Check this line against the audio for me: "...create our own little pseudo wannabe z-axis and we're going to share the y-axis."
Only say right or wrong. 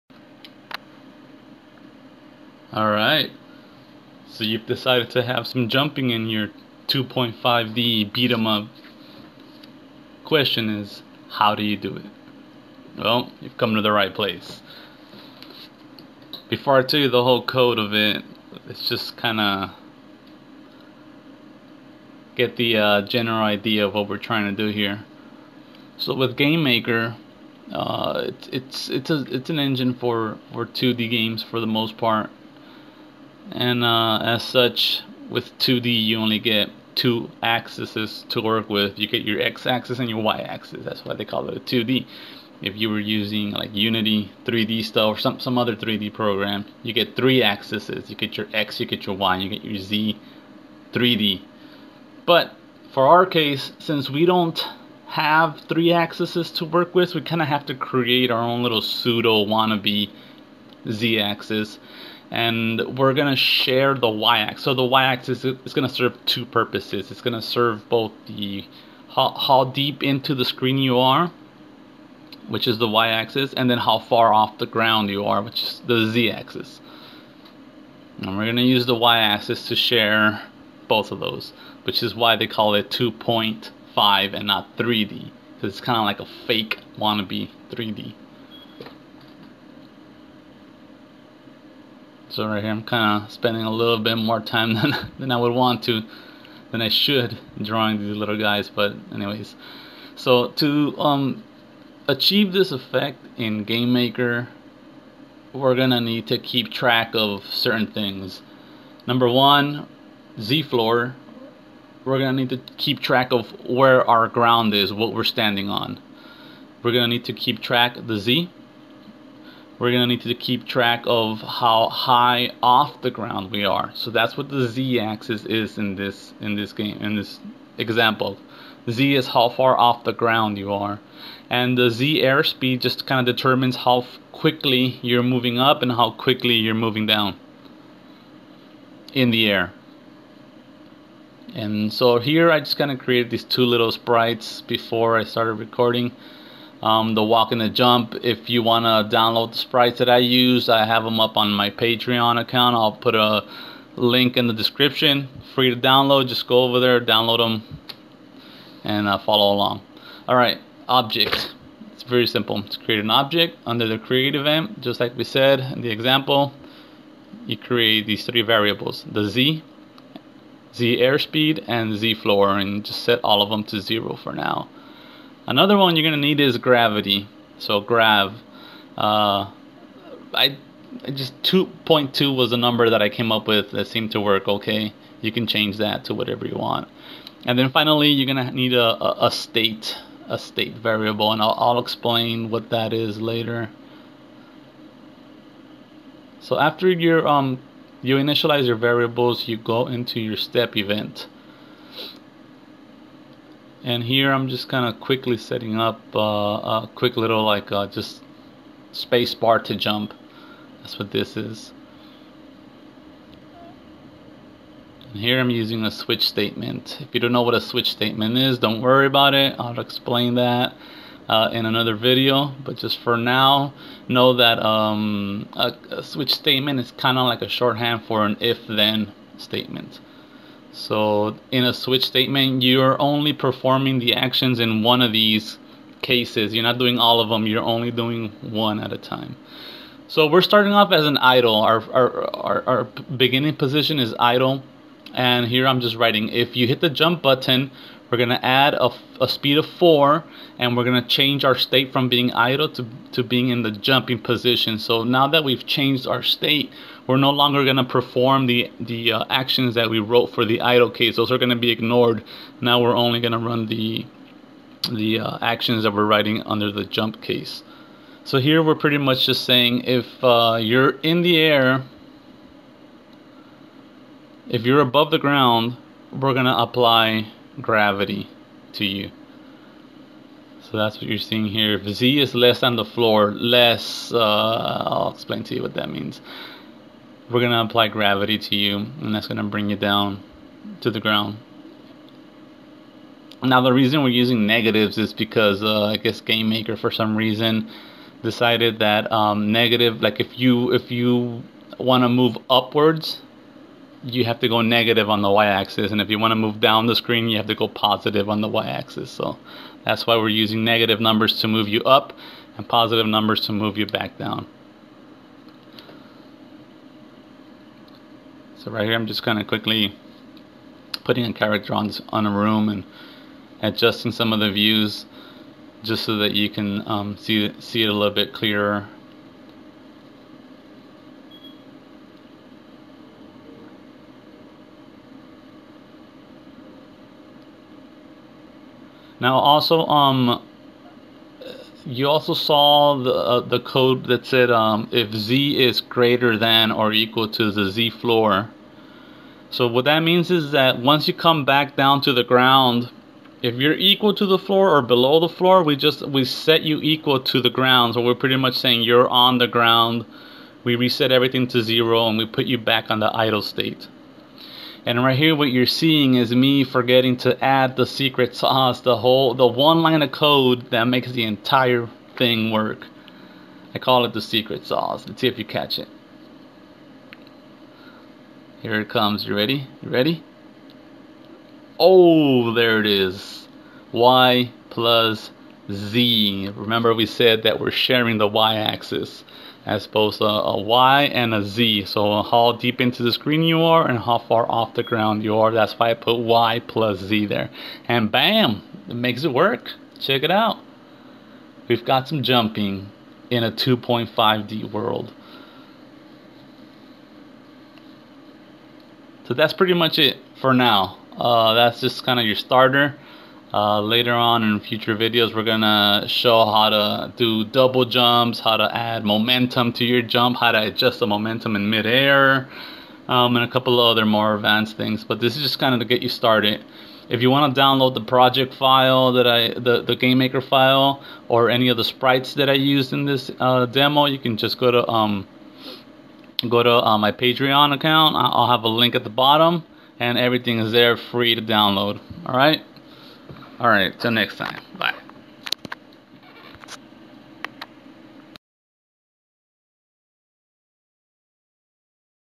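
right.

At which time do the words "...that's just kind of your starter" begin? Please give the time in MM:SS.
06:51.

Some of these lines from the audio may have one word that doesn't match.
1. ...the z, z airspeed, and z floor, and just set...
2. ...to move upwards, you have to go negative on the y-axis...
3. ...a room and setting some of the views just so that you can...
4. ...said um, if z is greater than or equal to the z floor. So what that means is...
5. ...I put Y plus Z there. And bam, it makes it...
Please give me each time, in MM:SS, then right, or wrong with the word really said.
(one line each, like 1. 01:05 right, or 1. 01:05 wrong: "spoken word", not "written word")
1. 02:49 right
2. 05:02 right
3. 05:22 wrong: "adjusting", not "setting"
4. 05:44 right
5. 06:35 right.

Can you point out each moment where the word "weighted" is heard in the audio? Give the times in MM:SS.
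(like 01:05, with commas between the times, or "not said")
not said.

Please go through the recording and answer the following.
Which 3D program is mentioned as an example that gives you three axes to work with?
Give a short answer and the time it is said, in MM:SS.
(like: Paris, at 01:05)
Unity 3D, at 00:43.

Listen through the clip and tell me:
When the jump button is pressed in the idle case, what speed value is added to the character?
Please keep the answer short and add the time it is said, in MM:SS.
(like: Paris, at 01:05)
4, at 04:09.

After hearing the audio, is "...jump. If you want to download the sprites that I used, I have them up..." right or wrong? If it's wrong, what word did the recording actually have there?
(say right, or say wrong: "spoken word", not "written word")
right.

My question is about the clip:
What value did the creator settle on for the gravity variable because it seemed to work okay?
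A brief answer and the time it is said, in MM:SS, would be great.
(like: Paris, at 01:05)
2.2, at 03:01.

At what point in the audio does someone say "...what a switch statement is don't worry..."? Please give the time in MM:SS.
03:37.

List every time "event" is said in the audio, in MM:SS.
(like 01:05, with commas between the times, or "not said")
02:44, 03:20.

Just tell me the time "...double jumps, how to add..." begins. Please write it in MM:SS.
06:57.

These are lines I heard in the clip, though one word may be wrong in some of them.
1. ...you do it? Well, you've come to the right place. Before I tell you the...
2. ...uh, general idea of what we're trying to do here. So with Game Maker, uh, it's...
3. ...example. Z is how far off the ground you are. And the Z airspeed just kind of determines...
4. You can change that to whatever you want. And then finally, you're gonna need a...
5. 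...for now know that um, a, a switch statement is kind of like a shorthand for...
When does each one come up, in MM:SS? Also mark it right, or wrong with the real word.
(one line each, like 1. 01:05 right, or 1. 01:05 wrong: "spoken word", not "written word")
1. 00:11 right
2. 00:22 right
3. 02:07 right
4. 03:05 right
5. 03:42 right.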